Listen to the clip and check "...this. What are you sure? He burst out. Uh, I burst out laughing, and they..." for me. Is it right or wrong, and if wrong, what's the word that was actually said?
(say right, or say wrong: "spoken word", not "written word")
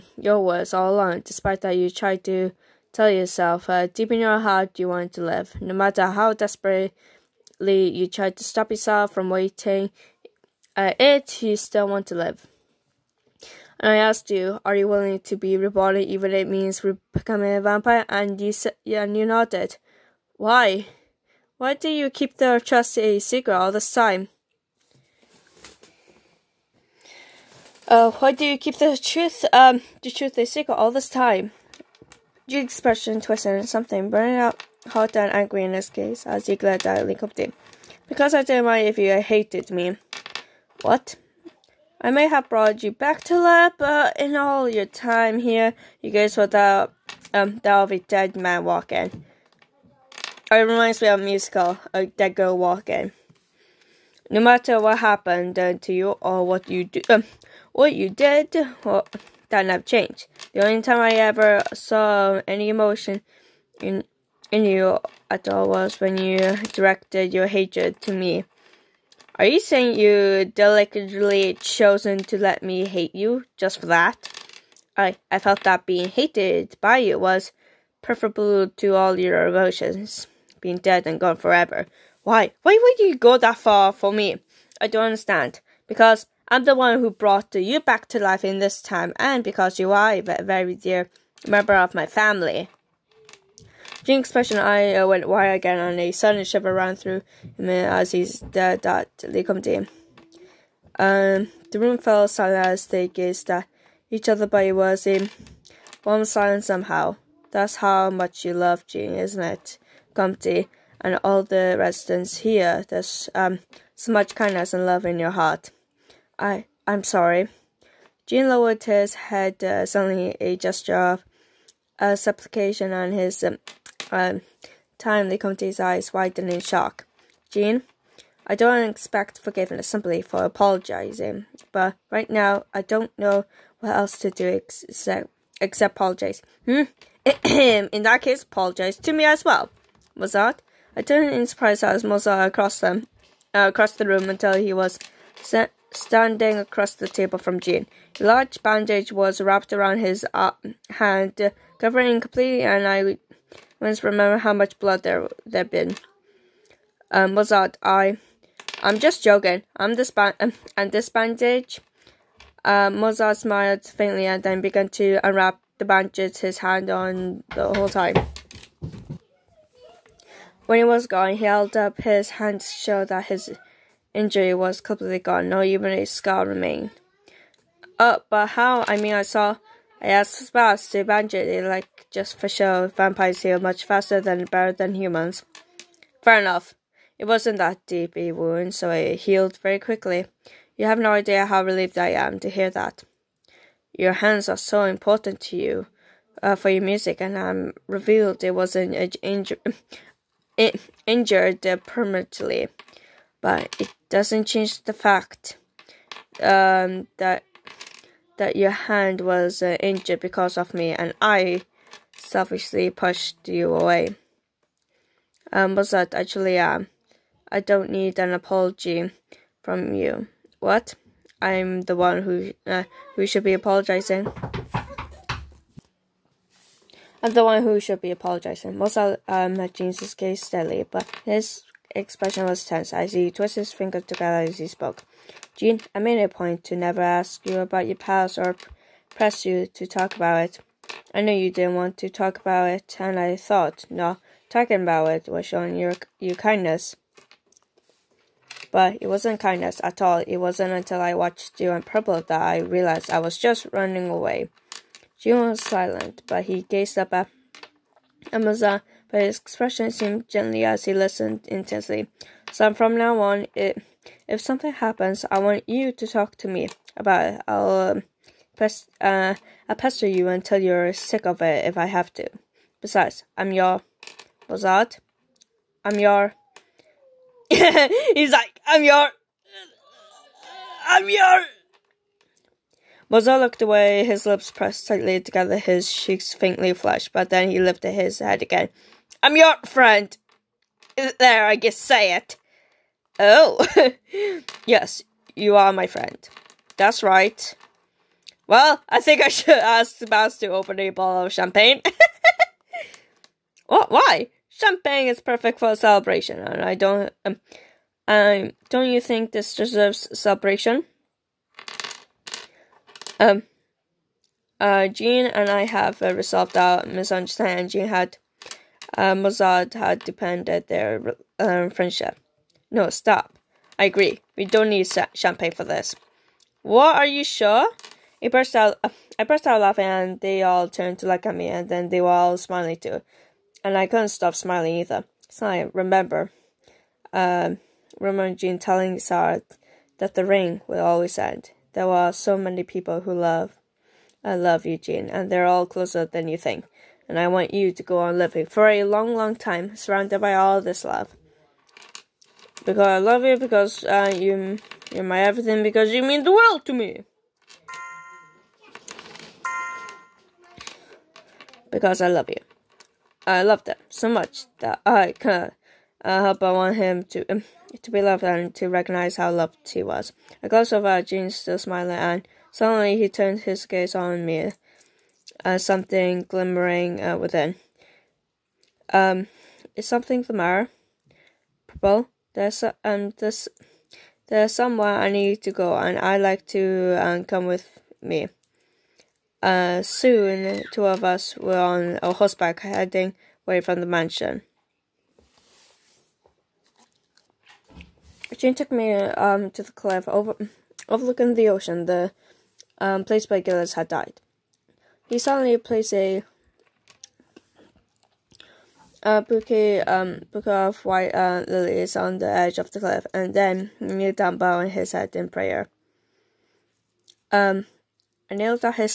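right.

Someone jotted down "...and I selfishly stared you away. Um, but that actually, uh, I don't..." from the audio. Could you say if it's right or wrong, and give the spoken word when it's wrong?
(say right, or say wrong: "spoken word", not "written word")
wrong: "pushed", not "stared".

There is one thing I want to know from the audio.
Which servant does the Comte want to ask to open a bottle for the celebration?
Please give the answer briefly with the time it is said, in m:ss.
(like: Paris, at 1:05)
Sebas, at 4:59.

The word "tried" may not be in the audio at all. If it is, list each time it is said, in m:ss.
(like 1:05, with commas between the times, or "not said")
0:01, 0:08.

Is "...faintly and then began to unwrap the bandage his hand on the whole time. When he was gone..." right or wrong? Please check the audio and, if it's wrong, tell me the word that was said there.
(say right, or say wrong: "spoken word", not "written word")
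right.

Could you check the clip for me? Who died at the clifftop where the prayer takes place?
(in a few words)
Gillis.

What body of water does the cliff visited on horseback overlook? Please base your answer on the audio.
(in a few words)
The ocean.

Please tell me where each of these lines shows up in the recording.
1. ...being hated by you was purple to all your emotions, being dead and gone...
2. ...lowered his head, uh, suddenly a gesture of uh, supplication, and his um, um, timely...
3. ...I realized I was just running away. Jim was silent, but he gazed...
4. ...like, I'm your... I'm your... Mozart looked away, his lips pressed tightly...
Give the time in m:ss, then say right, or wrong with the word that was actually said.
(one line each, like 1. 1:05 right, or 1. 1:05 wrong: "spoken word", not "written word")
1. 1:15 wrong: "preferable", not "purple"
2. 1:58 right
3. 4:12 right
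4. 4:38 right.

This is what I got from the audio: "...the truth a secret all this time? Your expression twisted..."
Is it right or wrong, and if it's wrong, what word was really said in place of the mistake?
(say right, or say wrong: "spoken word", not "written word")
right.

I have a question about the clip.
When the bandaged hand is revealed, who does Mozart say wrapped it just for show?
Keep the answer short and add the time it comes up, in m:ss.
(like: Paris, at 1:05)
Spouse, at 3:00.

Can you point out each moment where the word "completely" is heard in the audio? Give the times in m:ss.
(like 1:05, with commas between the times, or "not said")
2:32, 2:54.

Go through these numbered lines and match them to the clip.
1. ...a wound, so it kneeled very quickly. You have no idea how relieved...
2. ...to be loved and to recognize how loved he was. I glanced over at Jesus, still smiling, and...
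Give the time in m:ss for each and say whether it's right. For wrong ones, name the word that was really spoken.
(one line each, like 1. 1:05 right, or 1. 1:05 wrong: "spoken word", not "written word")
1. 3:08 wrong: "healed", not "kneeled"
2. 6:07 wrong: "Jean", not "Jesus".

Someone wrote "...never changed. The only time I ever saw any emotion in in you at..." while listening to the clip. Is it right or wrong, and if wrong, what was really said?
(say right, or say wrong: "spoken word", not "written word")
right.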